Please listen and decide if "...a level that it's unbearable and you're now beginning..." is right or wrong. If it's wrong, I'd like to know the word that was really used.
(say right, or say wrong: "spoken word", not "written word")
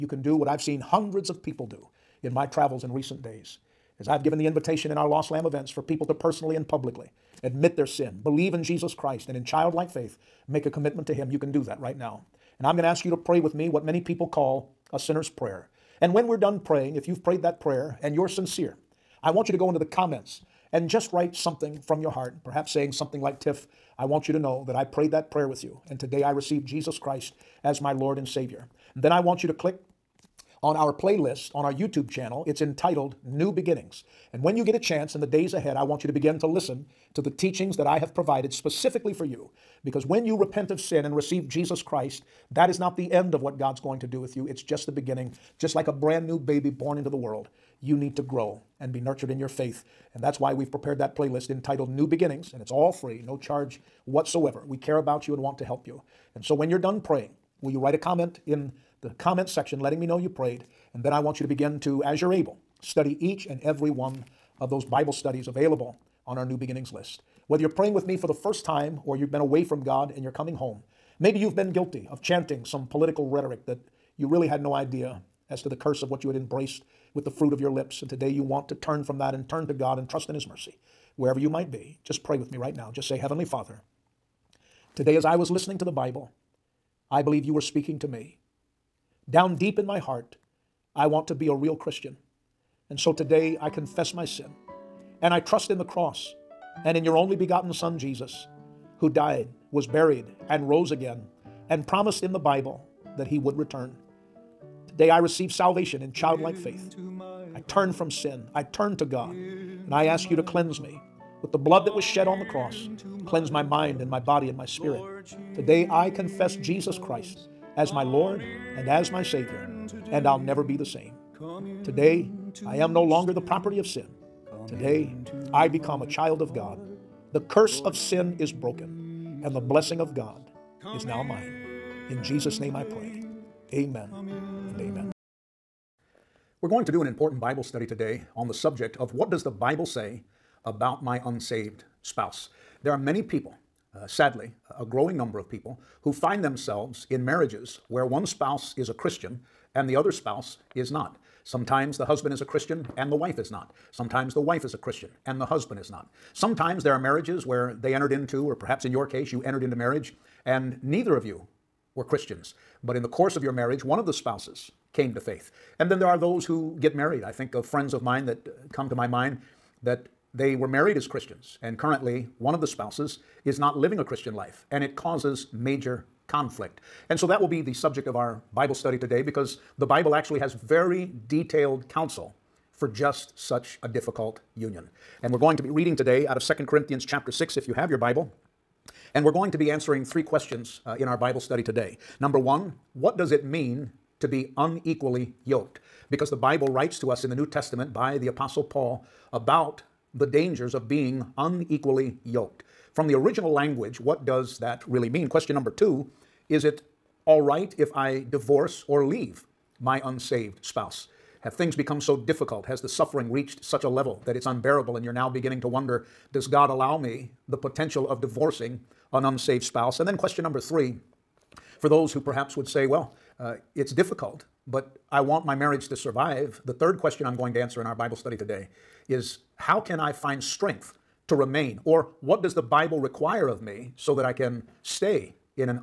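right.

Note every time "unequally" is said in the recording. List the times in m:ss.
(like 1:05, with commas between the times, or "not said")
3:14, 3:21.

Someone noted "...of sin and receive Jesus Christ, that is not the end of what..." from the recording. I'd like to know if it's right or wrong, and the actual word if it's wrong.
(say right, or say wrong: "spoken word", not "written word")
right.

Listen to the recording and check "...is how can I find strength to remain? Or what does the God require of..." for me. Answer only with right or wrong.
wrong.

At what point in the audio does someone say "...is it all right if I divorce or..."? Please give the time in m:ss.
3:26.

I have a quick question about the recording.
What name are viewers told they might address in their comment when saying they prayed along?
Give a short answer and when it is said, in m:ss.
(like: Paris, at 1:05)
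Tiff, at 0:23.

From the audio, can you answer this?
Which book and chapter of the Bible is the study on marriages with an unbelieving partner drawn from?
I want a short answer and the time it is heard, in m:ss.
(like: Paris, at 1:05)
Second Corinthians 6, at 3:06.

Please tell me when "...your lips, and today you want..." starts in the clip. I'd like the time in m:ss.
1:17.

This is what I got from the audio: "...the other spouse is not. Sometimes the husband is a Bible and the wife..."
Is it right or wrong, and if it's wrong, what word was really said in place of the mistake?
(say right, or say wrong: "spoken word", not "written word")
wrong: "Christian", not "Bible".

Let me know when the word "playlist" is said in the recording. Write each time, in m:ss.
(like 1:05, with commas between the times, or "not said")
0:30, 0:51.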